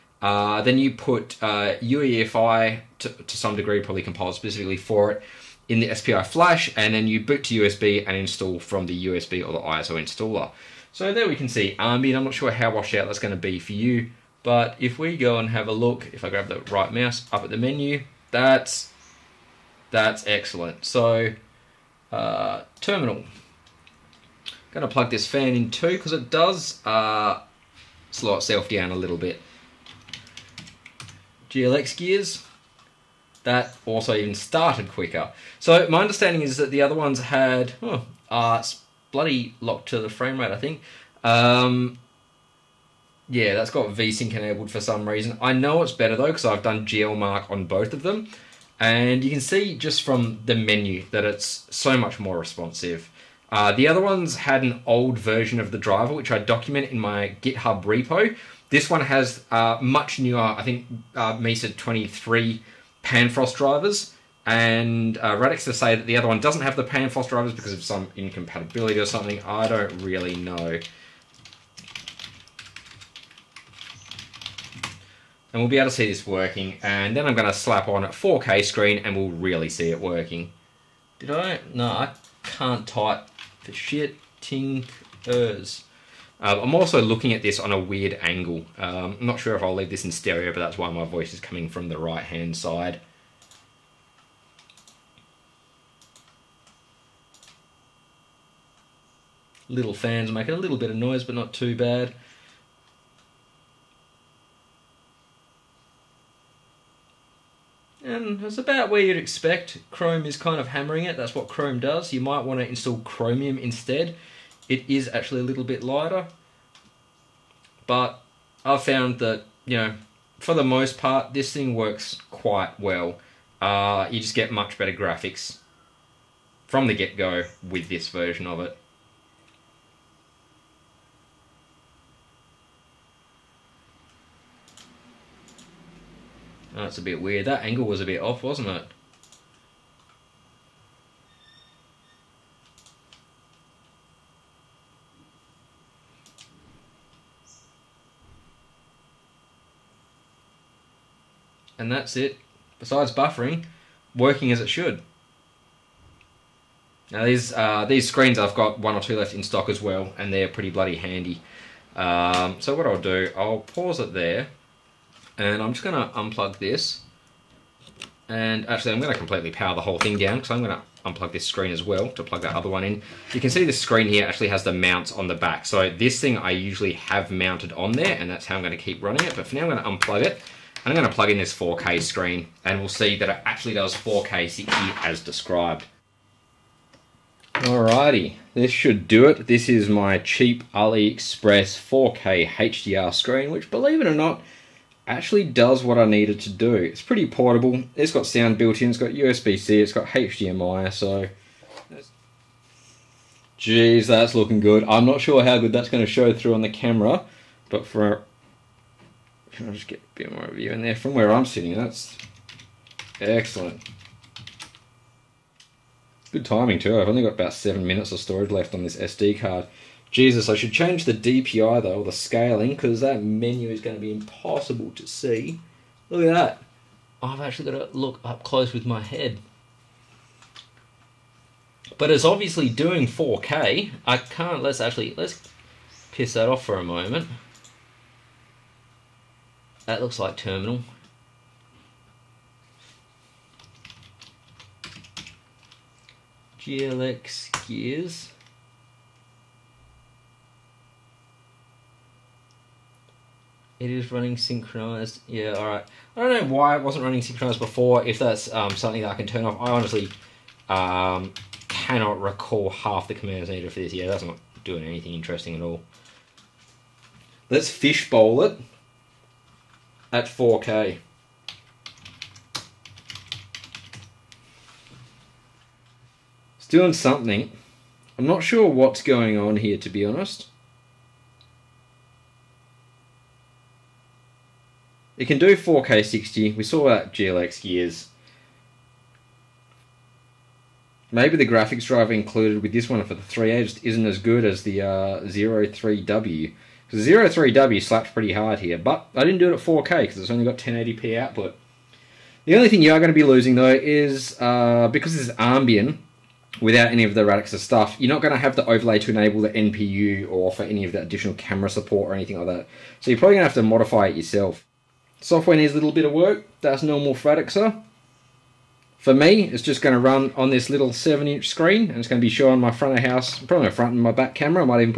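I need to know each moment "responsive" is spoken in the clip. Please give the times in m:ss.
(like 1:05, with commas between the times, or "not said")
0:52.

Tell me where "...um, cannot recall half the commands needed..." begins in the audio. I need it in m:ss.
4:20.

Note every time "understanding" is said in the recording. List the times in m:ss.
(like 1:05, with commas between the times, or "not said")
0:36.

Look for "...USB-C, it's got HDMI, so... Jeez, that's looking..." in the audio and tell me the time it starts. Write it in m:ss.
3:19.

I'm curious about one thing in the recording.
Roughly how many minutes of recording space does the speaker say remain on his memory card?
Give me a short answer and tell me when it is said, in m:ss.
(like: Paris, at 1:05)
7, at 3:37.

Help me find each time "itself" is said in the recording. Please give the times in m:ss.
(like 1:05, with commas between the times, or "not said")
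0:28.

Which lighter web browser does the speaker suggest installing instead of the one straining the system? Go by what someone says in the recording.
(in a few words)
Chromium.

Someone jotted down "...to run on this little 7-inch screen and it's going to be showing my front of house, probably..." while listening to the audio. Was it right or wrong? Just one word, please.
right.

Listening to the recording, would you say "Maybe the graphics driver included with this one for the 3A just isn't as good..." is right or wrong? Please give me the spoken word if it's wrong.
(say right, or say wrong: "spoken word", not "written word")
right.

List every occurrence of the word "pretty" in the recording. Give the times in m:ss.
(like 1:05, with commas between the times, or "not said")
2:40, 3:17, 4:58.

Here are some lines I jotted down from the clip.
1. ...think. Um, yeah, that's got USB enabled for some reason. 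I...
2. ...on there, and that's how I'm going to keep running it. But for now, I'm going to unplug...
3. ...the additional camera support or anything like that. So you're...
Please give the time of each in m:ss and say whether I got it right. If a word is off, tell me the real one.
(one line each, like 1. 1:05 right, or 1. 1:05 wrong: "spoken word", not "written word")
1. 0:40 wrong: "VSync", not "USB"
2. 2:57 right
3. 5:10 right.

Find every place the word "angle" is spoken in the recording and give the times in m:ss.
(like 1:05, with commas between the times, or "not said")
1:28, 2:17.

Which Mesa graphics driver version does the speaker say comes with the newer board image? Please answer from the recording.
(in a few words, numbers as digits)
23.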